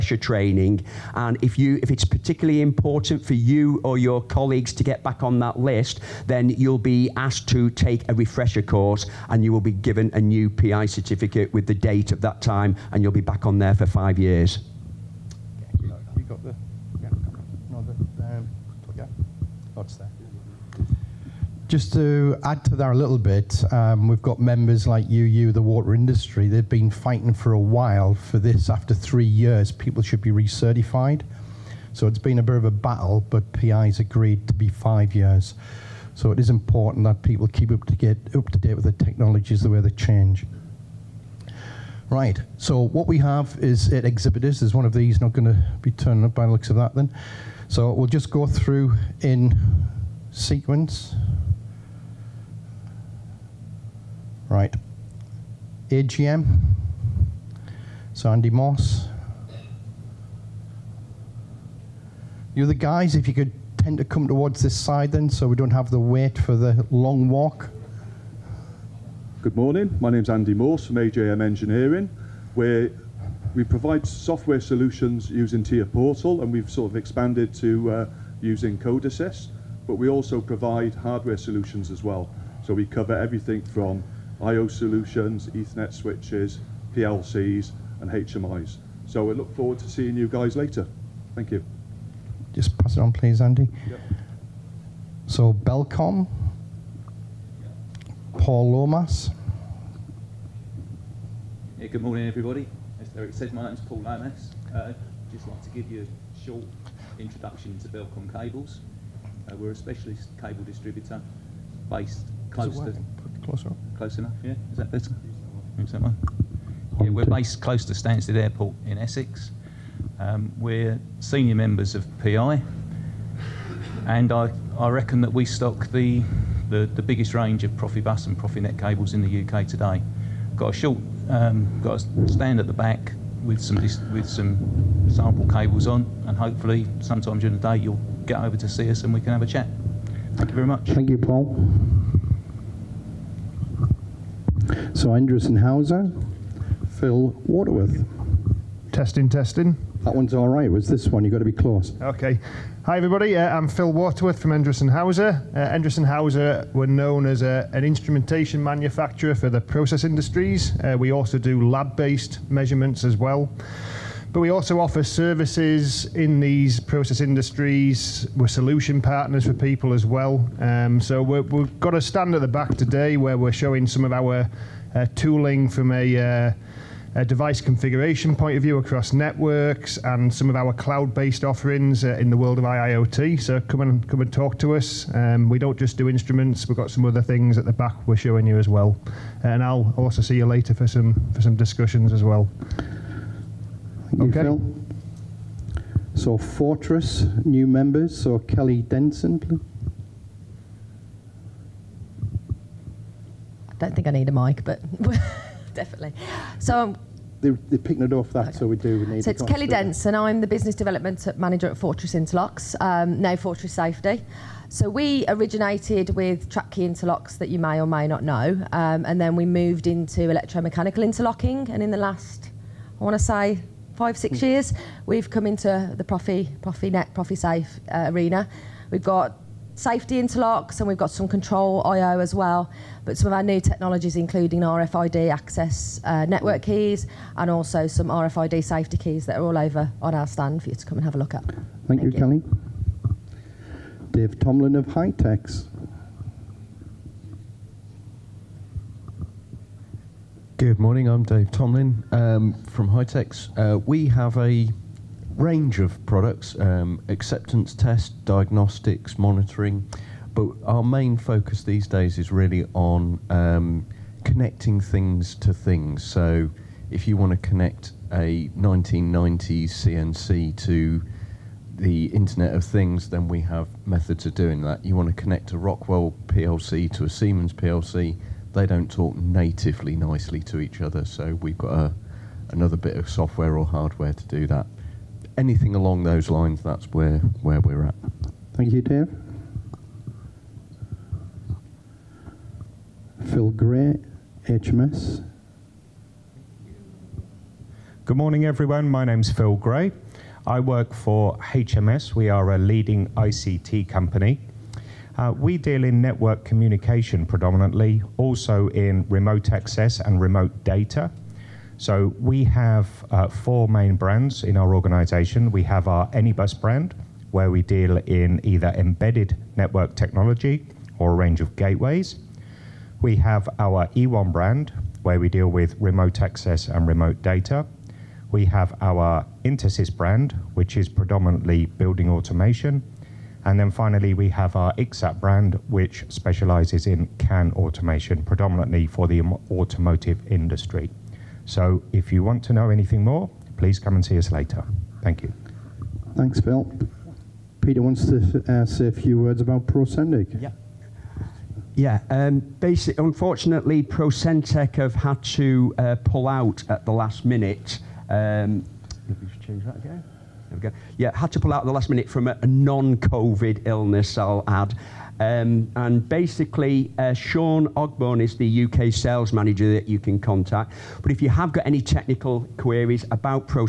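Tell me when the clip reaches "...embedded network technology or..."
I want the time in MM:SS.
05:18.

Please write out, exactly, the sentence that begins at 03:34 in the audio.
So we originated with trapped key interlocks that you may or may not know, um, and then we moved into electromechanical interlocking.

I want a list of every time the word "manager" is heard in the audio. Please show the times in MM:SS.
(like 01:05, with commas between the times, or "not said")
03:31, 06:09.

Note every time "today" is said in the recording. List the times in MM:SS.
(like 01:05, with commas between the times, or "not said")
02:09, 02:52.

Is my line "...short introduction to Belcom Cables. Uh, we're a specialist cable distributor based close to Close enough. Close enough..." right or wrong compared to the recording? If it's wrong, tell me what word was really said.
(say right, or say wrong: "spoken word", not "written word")
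right.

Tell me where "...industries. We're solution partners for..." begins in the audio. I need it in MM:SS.
02:47.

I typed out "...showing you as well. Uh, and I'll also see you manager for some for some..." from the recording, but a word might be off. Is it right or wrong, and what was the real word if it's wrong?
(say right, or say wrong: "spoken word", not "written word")
wrong: "later", not "manager".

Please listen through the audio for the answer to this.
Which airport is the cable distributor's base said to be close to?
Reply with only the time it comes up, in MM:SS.
01:57.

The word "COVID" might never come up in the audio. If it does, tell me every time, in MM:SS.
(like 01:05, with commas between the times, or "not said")
06:02.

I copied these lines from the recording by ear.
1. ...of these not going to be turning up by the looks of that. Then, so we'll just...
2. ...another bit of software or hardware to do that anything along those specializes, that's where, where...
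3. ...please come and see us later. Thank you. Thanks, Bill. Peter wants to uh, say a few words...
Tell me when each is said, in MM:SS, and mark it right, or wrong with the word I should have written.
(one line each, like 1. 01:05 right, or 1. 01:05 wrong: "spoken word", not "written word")
1. 00:44 right
2. 04:42 wrong: "lines", not "specializes"
3. 05:43 right.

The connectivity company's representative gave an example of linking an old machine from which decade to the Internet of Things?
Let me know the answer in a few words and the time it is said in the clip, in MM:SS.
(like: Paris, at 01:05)
1990s, at 04:28.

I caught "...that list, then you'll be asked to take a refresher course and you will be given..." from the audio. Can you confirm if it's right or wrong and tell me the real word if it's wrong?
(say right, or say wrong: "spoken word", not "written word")
right.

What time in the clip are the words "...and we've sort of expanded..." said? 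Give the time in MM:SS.
01:16.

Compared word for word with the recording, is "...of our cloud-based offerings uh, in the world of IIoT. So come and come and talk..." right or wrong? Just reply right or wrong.
right.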